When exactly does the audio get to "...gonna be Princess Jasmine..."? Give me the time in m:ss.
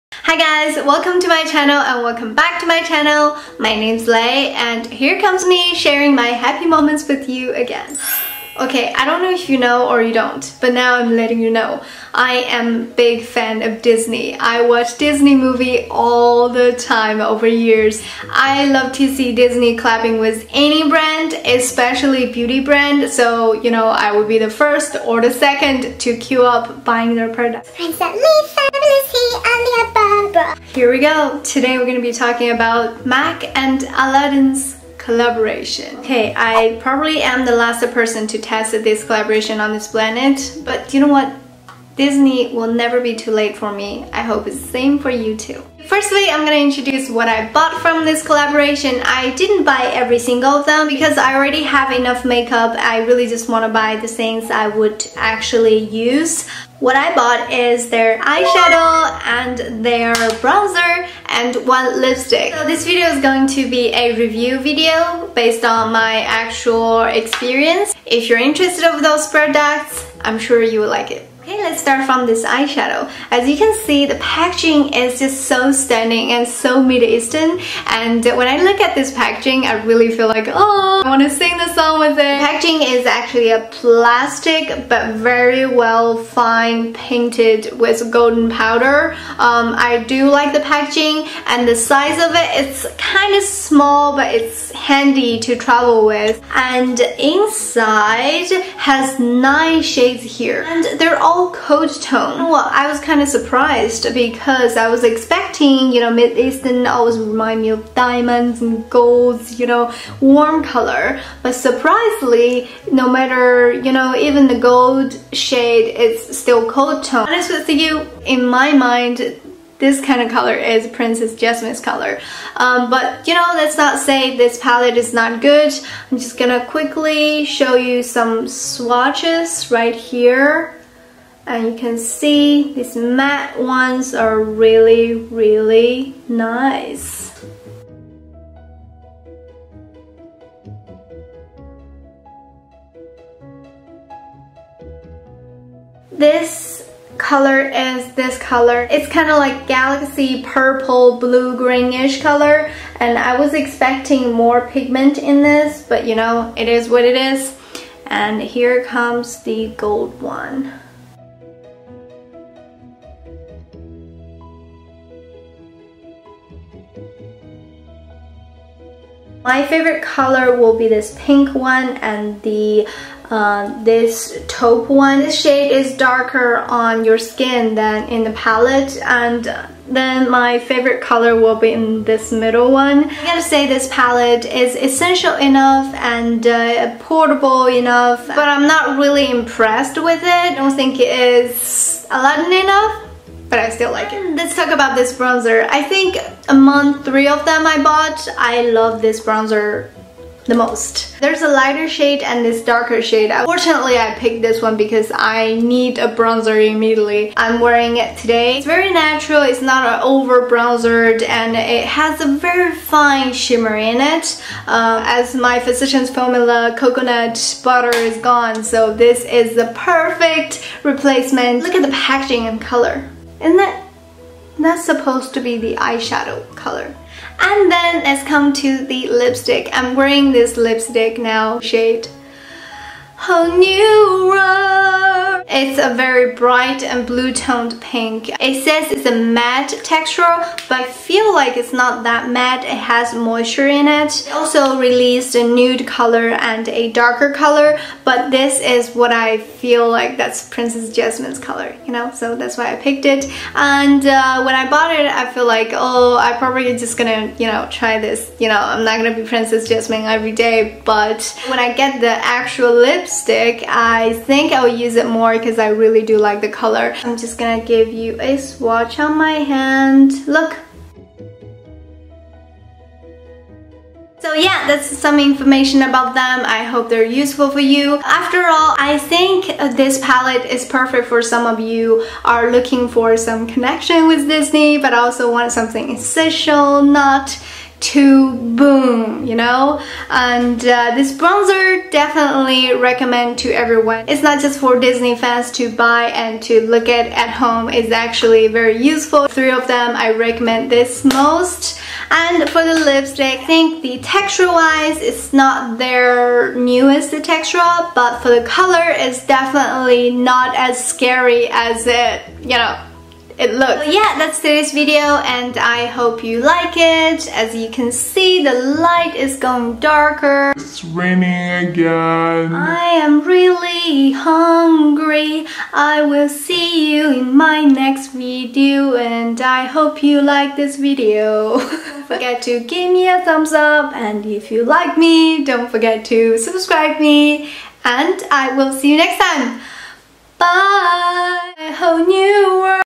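4:19.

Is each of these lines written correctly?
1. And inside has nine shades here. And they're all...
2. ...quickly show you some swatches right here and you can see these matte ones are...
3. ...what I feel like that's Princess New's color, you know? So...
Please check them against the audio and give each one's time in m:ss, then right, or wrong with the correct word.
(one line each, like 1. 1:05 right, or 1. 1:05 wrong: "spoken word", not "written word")
1. 1:36 right
2. 2:06 right
3. 4:08 wrong: "Jasmine", not "New".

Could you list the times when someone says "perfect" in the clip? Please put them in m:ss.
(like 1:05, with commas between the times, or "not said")
3:39, 4:40.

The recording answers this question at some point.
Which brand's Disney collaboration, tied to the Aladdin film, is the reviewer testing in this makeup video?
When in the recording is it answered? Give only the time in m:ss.
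0:33.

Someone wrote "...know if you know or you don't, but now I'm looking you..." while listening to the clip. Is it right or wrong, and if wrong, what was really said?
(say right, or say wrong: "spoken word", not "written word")
wrong: "letting", not "looking".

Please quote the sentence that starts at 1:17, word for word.
And when I look at this packaging, I really feel like, oh, I want to sing the song with it.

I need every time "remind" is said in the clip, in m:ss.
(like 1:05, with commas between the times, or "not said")
1:47.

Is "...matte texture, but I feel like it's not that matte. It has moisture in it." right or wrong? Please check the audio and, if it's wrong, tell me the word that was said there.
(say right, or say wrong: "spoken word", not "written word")
right.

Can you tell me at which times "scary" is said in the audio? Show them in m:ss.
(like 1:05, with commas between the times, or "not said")
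5:10.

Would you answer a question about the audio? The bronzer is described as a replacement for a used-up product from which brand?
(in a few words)
Physicians Formula.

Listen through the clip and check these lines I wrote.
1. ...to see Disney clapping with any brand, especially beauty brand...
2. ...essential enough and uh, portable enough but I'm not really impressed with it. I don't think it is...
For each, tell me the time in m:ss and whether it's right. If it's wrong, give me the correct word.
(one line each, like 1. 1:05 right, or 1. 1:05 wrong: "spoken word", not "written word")
1. 0:18 right
2. 3:04 right.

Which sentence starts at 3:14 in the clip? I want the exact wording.
Mm, let's talk about this bronzer.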